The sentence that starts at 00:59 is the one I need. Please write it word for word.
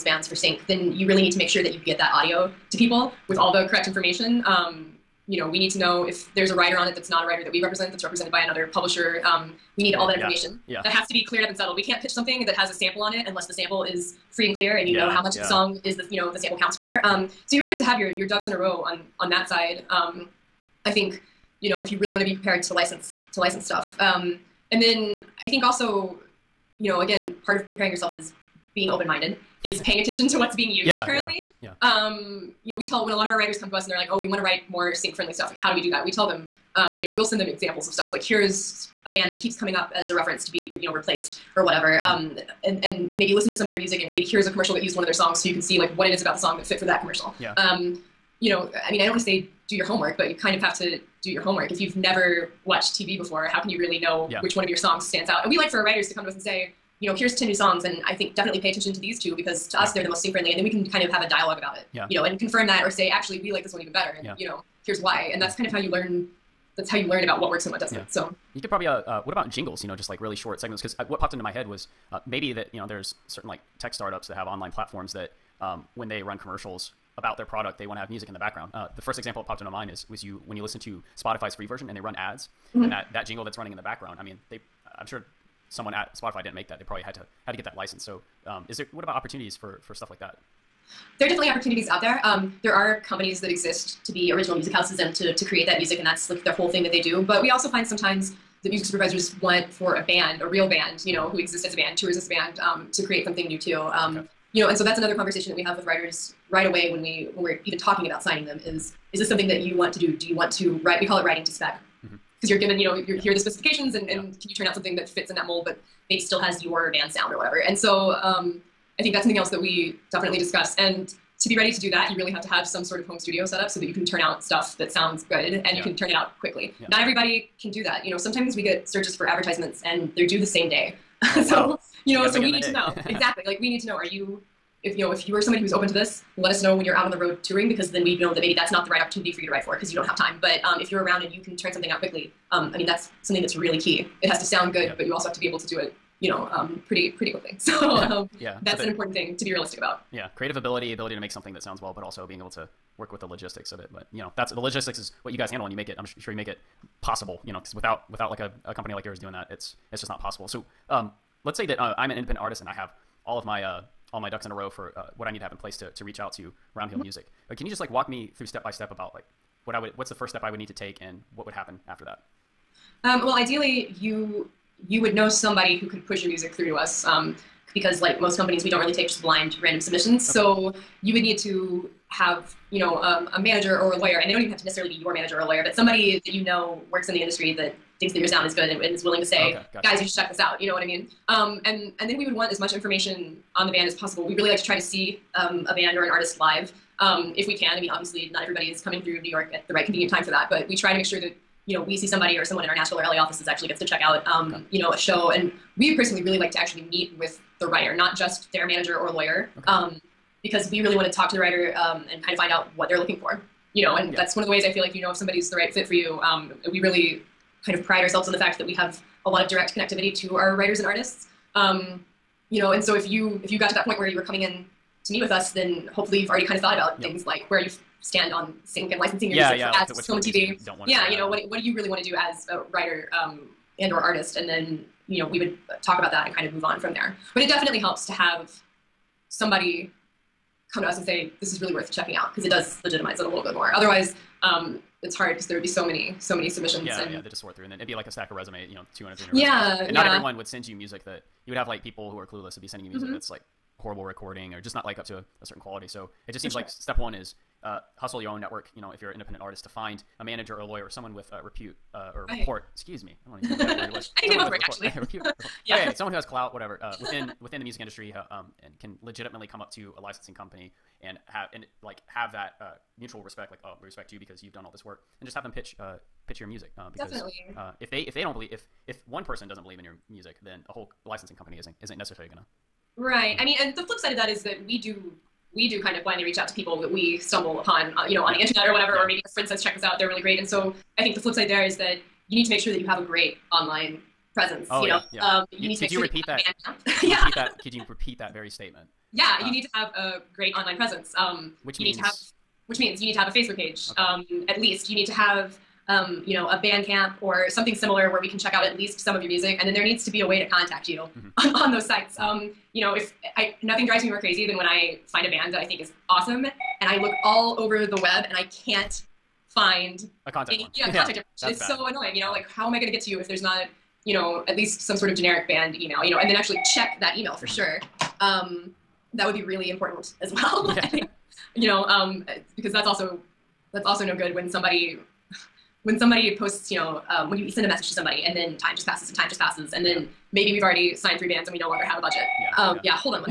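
they're the most sync friendly, and then we can kind of have a dialogue about it.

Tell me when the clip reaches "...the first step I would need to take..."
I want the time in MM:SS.
02:50.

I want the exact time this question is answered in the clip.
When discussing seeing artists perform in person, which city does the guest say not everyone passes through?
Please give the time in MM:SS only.
03:19.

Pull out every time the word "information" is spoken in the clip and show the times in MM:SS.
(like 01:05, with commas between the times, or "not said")
00:03, 00:10, 03:12, 05:21.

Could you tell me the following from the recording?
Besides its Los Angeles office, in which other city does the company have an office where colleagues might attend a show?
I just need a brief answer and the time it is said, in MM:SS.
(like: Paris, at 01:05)
Nashville, at 03:22.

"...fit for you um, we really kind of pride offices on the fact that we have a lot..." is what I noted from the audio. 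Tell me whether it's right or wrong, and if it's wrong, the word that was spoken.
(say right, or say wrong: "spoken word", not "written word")
wrong: "ourselves", not "offices".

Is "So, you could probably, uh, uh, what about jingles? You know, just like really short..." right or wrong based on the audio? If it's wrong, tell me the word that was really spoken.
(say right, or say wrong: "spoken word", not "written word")
right.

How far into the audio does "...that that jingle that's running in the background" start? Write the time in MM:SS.
01:22.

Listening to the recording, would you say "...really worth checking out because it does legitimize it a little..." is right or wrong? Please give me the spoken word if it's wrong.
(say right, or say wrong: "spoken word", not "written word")
right.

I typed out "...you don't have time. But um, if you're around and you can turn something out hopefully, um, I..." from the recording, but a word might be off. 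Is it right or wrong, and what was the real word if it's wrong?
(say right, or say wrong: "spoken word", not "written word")
wrong: "quickly", not "hopefully".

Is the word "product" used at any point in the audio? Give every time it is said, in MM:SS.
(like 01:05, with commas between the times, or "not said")
01:17.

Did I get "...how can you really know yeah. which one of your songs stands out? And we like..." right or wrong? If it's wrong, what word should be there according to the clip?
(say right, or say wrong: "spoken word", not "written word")
right.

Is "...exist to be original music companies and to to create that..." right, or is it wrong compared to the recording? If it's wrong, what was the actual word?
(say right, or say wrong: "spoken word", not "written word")
wrong: "houses", not "companies".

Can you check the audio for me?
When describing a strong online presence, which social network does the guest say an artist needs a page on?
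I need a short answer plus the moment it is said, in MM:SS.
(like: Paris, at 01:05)
Facebook, at 05:03.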